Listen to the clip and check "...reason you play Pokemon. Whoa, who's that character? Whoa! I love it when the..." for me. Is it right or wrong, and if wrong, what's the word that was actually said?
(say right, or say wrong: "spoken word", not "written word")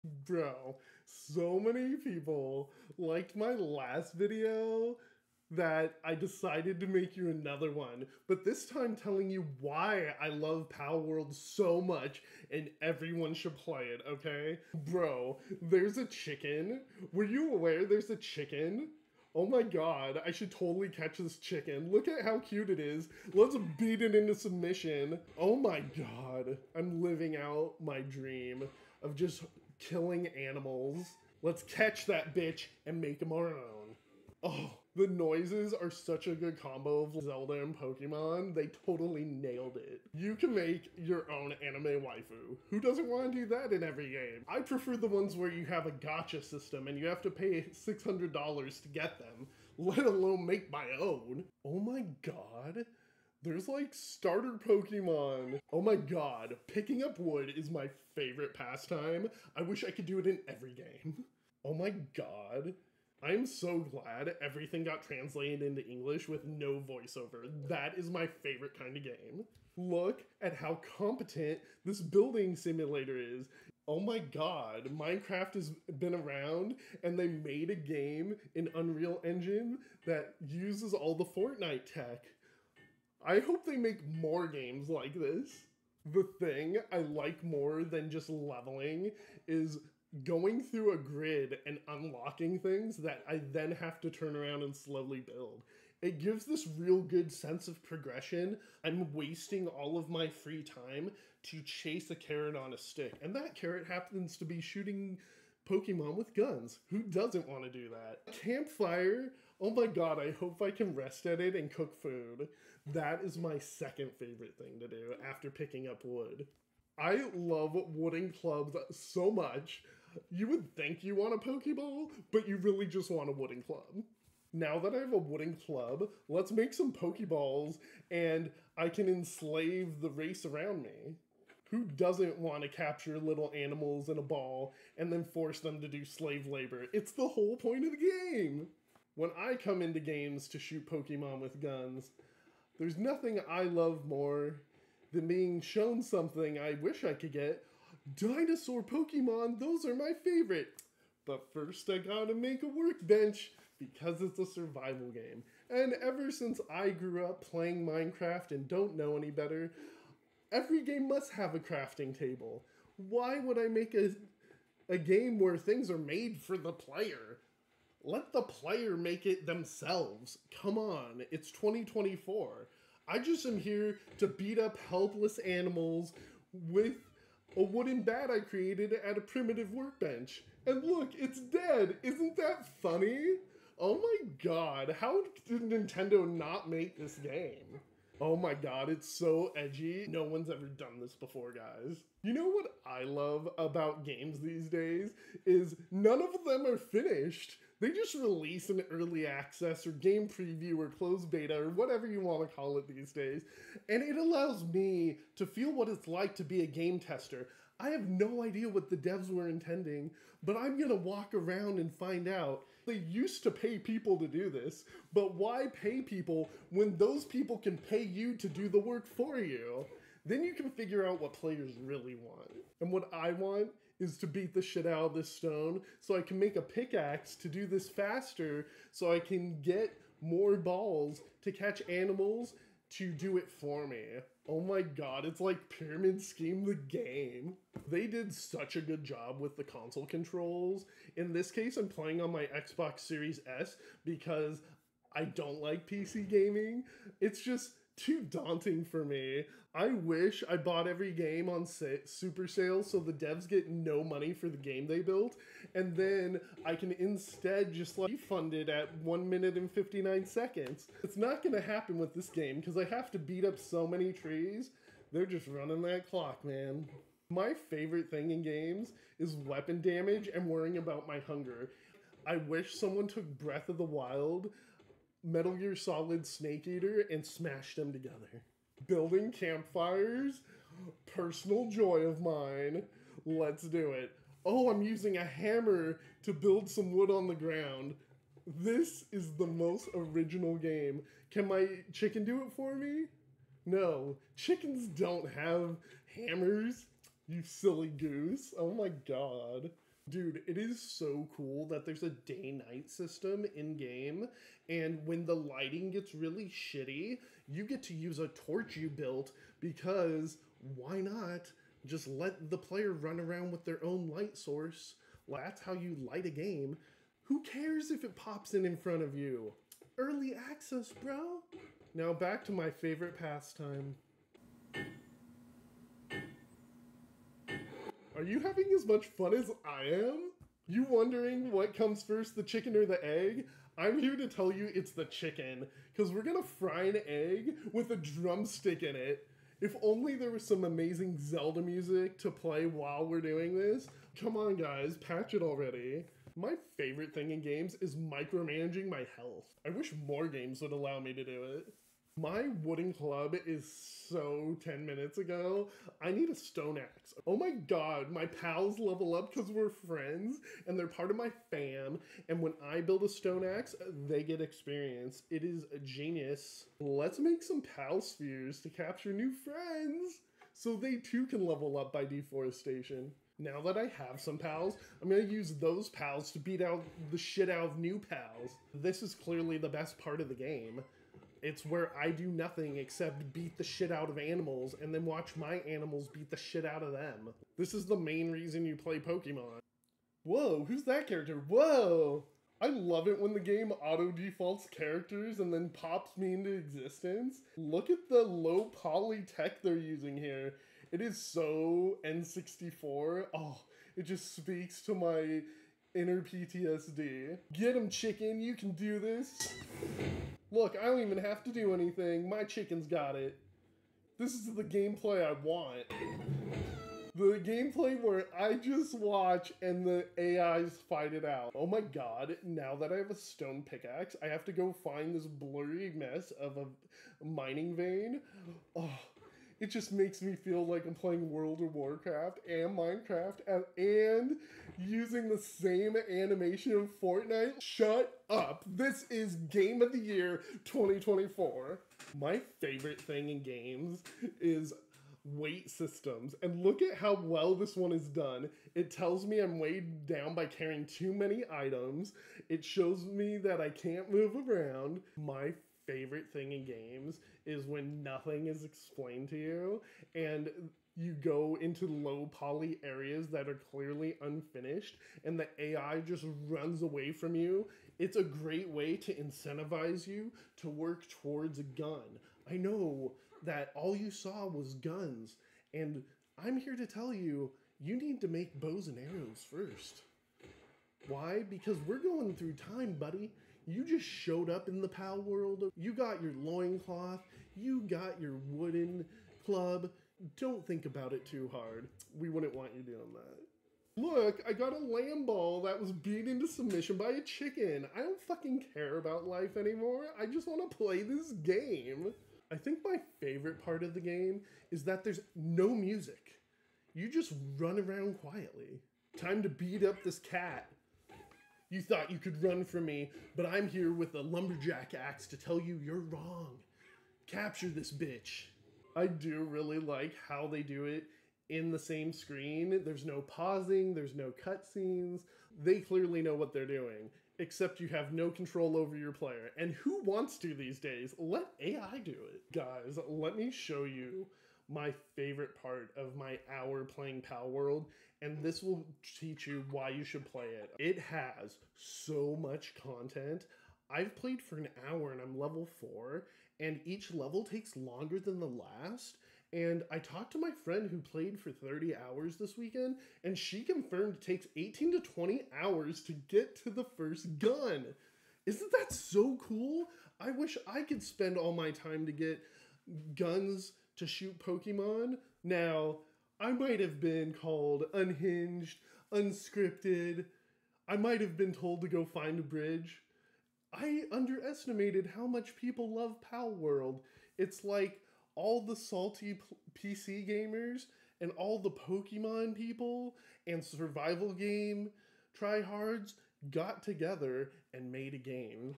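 right.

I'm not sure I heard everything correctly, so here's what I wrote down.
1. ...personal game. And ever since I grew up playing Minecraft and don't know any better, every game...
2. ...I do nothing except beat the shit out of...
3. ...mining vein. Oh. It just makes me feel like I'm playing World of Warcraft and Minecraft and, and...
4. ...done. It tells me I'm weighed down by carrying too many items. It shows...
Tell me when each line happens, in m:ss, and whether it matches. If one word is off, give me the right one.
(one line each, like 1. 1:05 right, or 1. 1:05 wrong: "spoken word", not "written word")
1. 2:34 wrong: "survival", not "personal"
2. 6:21 right
3. 7:07 right
4. 7:28 right.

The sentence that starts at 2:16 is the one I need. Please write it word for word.
It's the whole point of the game!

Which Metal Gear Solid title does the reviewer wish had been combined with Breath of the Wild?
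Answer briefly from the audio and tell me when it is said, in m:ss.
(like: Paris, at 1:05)
Snake Eater, at 4:36.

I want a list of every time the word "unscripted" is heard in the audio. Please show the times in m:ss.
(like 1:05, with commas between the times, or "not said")
9:29.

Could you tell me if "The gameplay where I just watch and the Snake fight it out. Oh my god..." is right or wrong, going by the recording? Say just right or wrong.
wrong.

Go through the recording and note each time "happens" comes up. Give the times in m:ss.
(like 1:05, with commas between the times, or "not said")
1:43, 4:21.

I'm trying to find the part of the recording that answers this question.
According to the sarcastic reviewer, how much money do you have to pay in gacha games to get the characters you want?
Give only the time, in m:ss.
0:47.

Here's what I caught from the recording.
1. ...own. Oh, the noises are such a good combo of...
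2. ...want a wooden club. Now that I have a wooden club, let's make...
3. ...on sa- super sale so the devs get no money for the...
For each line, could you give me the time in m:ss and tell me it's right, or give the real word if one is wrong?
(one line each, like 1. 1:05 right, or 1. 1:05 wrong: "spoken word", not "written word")
1. 0:33 right
2. 2:03 right
3. 4:11 right.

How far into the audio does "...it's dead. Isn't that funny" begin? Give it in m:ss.
3:01.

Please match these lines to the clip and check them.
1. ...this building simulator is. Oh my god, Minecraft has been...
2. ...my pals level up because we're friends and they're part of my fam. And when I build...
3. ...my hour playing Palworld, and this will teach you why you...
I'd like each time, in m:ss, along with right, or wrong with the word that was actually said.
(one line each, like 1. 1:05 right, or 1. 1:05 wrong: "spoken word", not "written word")
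1. 1:11 right
2. 5:58 right
3. 8:56 right.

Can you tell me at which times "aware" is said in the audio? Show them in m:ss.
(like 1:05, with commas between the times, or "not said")
0:17.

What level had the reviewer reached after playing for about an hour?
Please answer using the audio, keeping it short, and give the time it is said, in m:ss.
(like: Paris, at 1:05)
4, at 9:05.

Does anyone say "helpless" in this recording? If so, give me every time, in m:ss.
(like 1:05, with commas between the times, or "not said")
2:54.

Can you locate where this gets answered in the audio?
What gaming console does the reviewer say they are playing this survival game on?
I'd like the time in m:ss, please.
4:02.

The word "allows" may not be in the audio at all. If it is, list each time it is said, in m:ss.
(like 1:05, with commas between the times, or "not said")
3:24, 5:50.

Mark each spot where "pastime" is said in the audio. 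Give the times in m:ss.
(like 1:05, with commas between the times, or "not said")
0:58, 5:23.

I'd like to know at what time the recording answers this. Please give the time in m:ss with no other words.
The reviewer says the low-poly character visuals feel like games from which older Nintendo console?
6:42.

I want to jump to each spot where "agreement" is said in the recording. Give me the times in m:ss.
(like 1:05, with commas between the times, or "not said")
not said.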